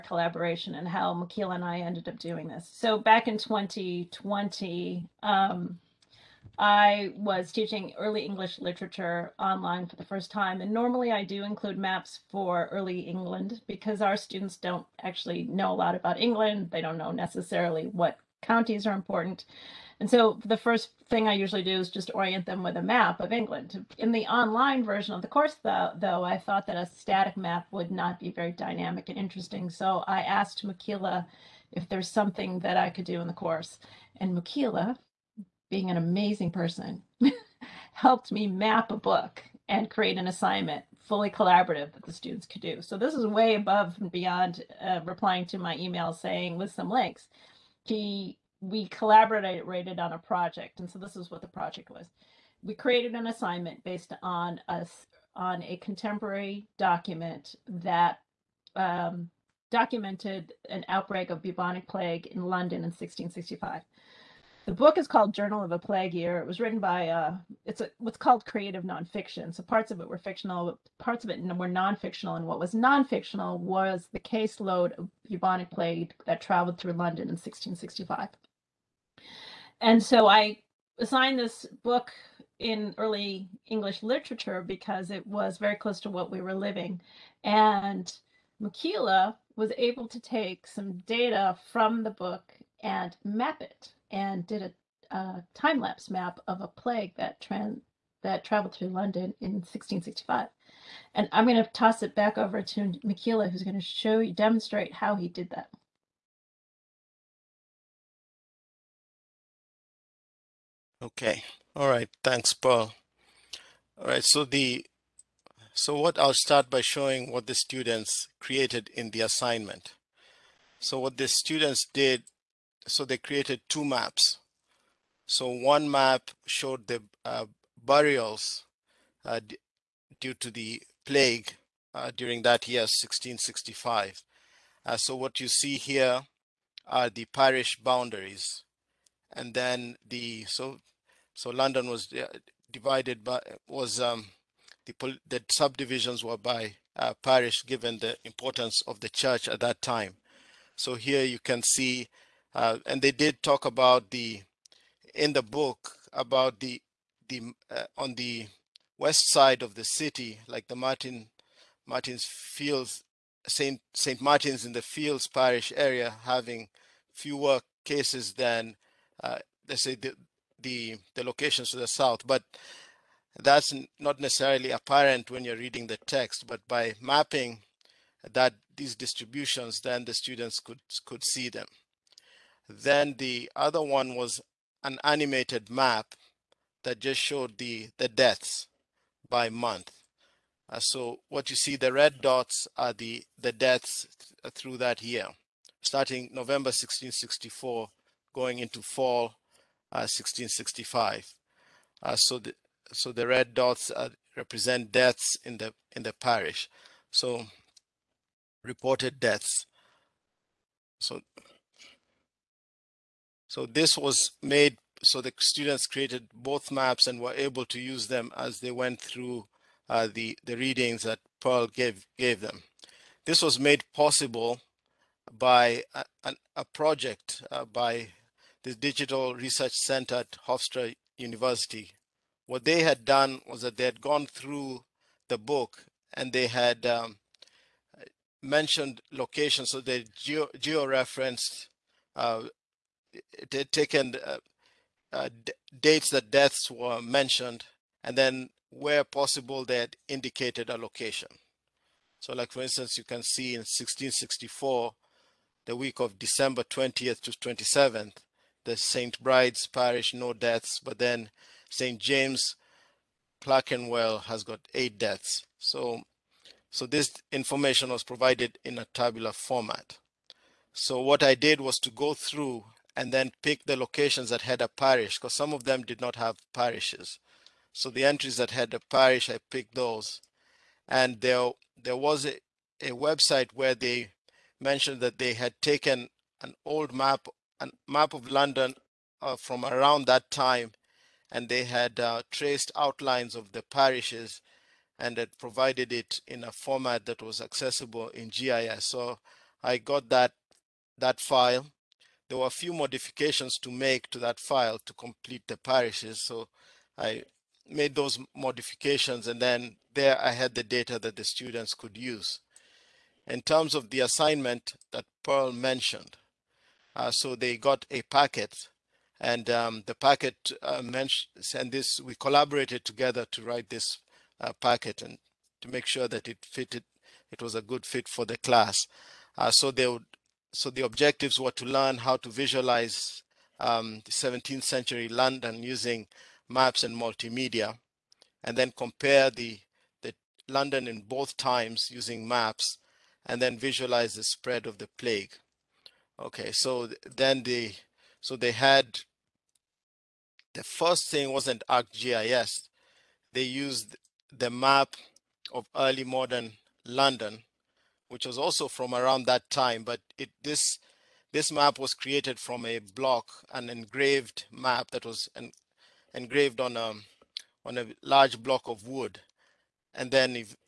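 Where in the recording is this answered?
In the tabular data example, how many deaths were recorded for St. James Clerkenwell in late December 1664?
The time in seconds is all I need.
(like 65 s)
264 s.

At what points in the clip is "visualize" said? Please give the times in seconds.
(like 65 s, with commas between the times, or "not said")
332 s, 343 s.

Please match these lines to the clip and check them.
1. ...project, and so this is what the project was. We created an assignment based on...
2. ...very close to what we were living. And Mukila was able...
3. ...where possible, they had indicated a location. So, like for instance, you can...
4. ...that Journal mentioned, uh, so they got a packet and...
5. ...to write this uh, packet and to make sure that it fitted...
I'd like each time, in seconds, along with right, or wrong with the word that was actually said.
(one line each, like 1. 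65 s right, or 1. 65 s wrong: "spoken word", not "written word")
1. 50 s right
2. 85 s right
3. 248 s right
4. 314 s wrong: "Pearl", not "Journal"
5. 323 s right.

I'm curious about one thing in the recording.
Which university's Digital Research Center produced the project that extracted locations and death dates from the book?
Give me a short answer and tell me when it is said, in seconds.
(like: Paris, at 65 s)
Hofstra University, at 230 s.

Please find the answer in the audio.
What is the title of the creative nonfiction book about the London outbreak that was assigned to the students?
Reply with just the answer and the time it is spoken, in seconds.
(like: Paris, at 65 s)
Journal of a Plague Year, at 65 s.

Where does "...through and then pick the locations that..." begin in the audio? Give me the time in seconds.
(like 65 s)
272 s.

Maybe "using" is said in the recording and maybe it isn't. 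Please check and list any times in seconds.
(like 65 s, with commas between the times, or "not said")
335 s, 341 s.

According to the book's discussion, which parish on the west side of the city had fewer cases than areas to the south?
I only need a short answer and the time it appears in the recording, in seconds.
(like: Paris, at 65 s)
Saint Martin's in the Fields, at 163 s.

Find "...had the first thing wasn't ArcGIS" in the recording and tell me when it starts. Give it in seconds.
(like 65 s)
348 s.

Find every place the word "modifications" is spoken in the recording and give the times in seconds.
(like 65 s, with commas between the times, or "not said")
302 s, 308 s.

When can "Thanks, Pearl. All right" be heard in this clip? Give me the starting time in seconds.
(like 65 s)
112 s.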